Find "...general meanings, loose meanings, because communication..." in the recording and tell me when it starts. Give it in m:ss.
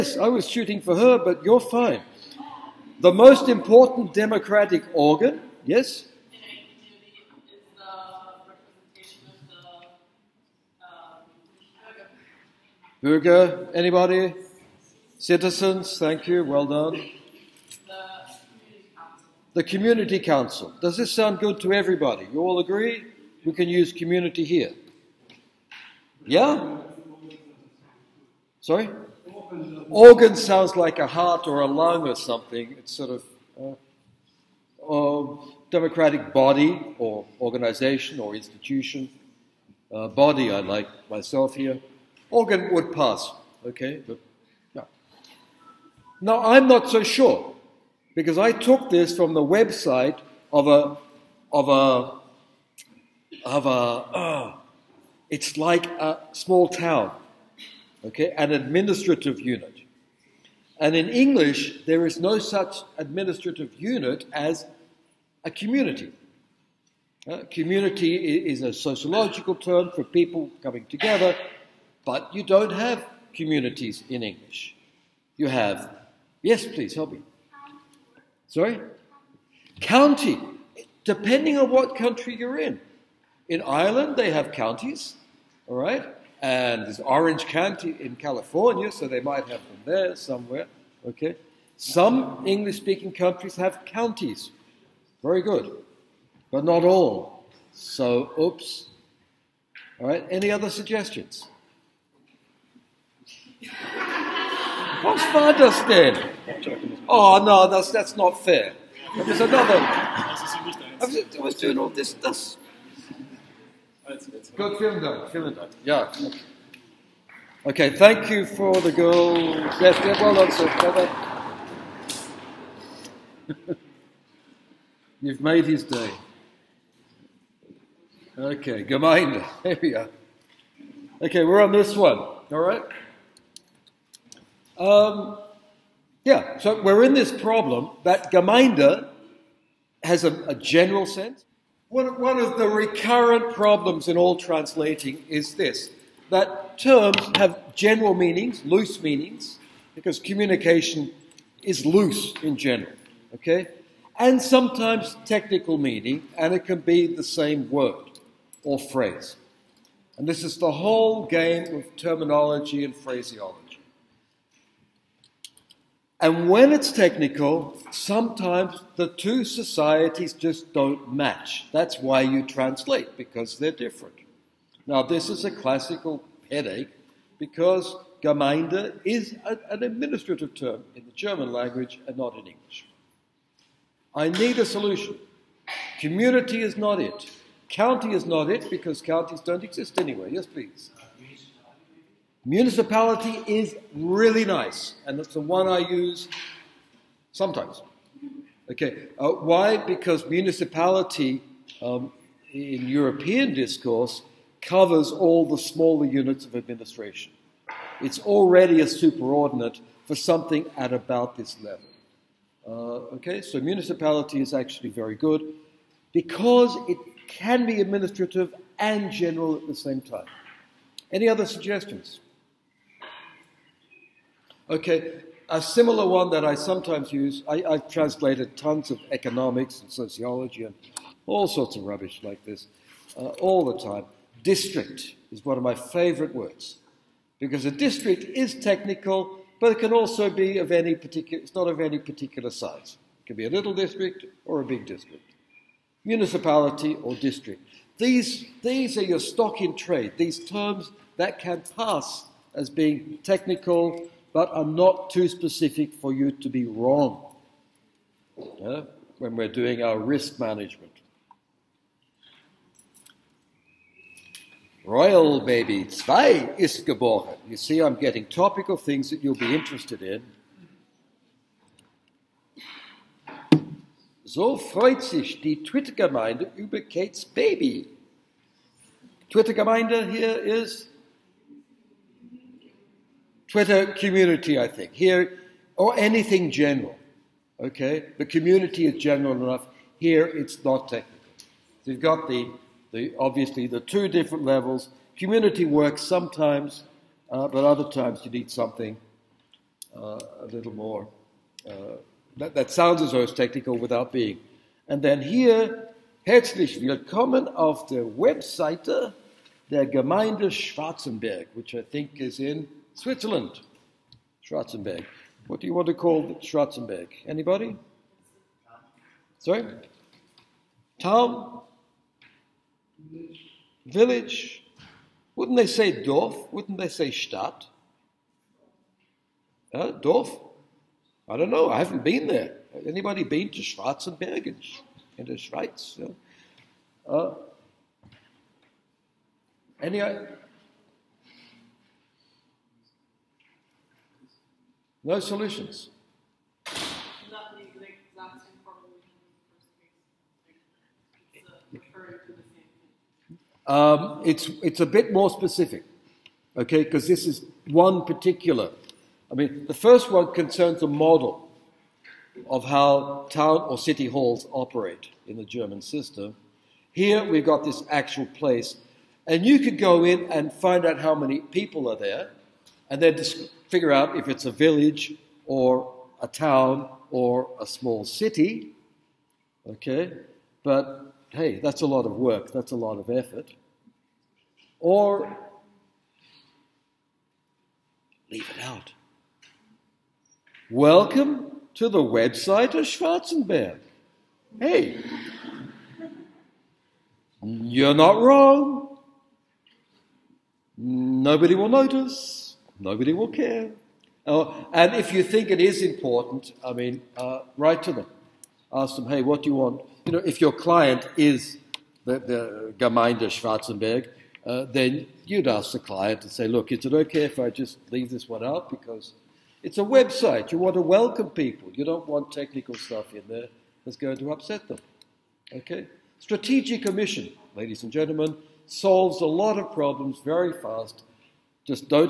2:27.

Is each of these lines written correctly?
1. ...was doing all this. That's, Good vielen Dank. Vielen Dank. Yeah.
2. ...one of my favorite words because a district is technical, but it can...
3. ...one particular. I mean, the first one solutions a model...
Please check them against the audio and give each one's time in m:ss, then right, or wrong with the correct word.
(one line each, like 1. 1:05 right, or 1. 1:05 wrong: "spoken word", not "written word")
1. 1:51 right
2. 3:55 right
3. 5:57 wrong: "concerns", not "solutions".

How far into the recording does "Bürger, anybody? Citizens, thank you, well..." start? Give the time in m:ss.
0:13.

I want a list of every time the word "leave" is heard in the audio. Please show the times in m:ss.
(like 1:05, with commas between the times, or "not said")
6:28, 6:57.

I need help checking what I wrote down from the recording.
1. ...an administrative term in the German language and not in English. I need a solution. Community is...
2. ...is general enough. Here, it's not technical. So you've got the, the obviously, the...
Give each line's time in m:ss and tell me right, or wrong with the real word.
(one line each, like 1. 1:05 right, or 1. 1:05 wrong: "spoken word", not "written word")
1. 2:59 right
2. 4:48 right.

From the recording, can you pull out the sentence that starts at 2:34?
And sometimes technical meaning, and it can be the same word or phrase.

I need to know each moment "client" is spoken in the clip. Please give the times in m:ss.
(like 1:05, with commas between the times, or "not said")
6:50, 6:55.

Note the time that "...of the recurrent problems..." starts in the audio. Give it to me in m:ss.
2:22.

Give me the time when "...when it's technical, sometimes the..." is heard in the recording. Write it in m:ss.
2:46.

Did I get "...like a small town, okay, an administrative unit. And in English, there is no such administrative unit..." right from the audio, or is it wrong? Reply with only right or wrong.
right.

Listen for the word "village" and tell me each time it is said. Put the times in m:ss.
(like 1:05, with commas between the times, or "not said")
5:23, 6:14.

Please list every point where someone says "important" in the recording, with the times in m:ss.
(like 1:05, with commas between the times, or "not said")
0:03, 6:45.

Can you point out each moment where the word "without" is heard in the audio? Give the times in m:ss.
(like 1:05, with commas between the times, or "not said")
5:03.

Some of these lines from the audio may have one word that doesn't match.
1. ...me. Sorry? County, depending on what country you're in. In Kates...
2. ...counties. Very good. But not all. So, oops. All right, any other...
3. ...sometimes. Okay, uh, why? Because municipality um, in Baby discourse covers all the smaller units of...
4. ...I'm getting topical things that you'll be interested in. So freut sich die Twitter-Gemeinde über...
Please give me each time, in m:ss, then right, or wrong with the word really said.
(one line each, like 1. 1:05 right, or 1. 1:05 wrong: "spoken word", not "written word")
1. 1:17 wrong: "Ireland", not "Kates"
2. 1:33 right
3. 3:17 wrong: "European", not "Baby"
4. 4:27 right.